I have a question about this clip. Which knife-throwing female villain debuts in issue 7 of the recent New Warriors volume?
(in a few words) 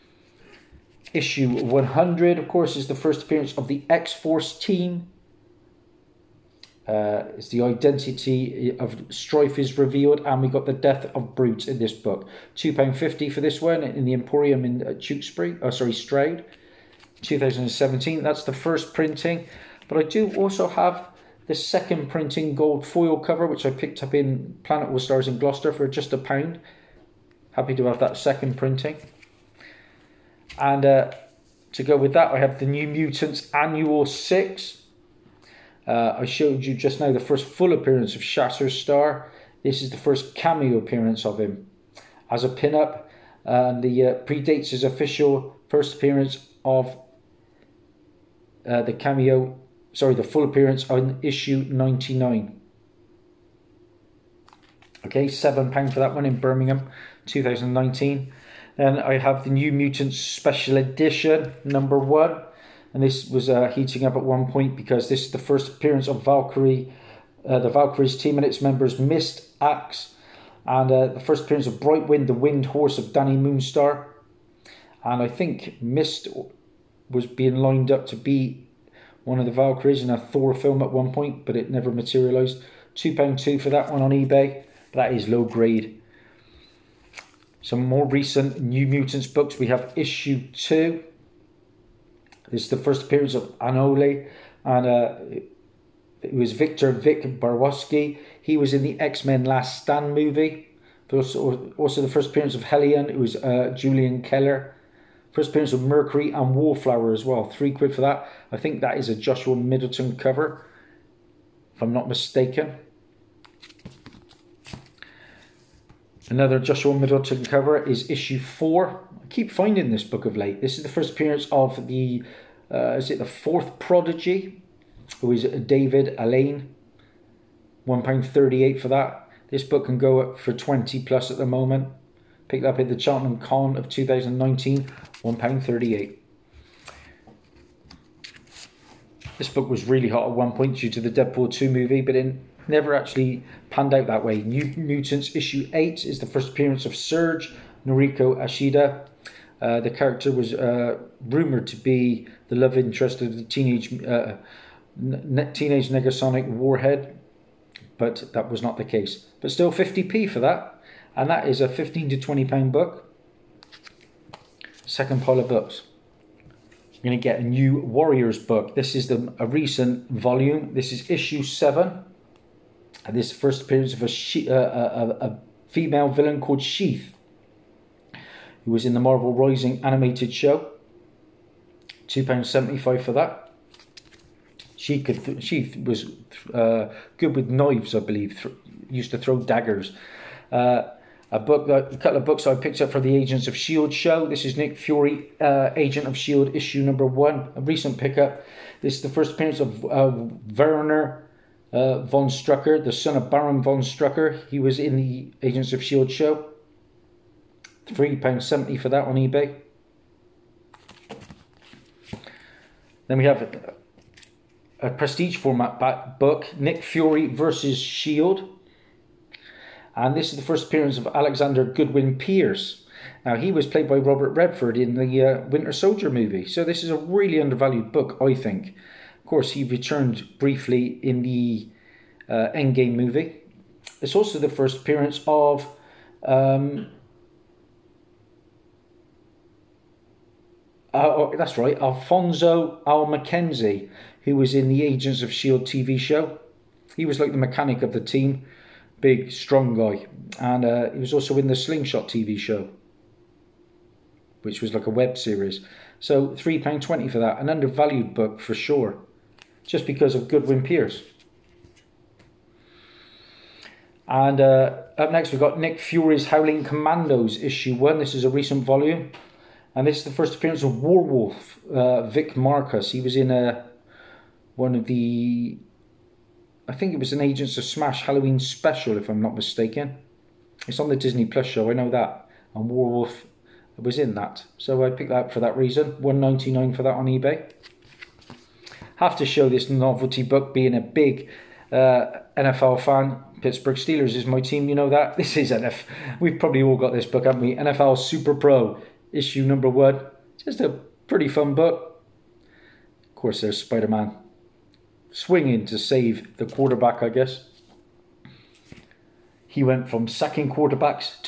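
Sheath.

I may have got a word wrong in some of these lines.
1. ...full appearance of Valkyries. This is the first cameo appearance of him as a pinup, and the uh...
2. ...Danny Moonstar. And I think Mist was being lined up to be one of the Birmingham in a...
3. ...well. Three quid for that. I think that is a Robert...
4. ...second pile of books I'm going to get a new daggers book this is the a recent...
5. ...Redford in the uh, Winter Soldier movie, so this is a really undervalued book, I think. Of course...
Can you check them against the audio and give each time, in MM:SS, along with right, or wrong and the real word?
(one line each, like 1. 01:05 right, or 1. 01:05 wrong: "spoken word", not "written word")
1. 00:37 wrong: "Shatterstar", not "Valkyries"
2. 01:13 wrong: "Valkyries", not "Birmingham"
3. 01:47 wrong: "Joshua", not "Robert"
4. 02:44 wrong: "warriors", not "daggers"
5. 03:44 right.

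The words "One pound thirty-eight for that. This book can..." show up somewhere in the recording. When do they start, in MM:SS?
02:07.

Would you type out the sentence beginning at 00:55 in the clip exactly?
Okay, £7 for that one in Birmingham 2019.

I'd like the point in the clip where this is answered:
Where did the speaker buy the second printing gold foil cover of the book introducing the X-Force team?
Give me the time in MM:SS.
00:24.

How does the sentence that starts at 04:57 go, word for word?
NFL Super Pro, issue number one.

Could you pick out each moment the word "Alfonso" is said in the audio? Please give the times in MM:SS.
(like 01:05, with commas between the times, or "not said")
04:01.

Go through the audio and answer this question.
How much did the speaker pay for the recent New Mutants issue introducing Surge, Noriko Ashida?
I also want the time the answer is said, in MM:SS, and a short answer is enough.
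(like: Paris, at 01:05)
50p, at 02:39.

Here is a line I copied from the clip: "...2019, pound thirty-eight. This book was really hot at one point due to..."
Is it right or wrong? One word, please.
right.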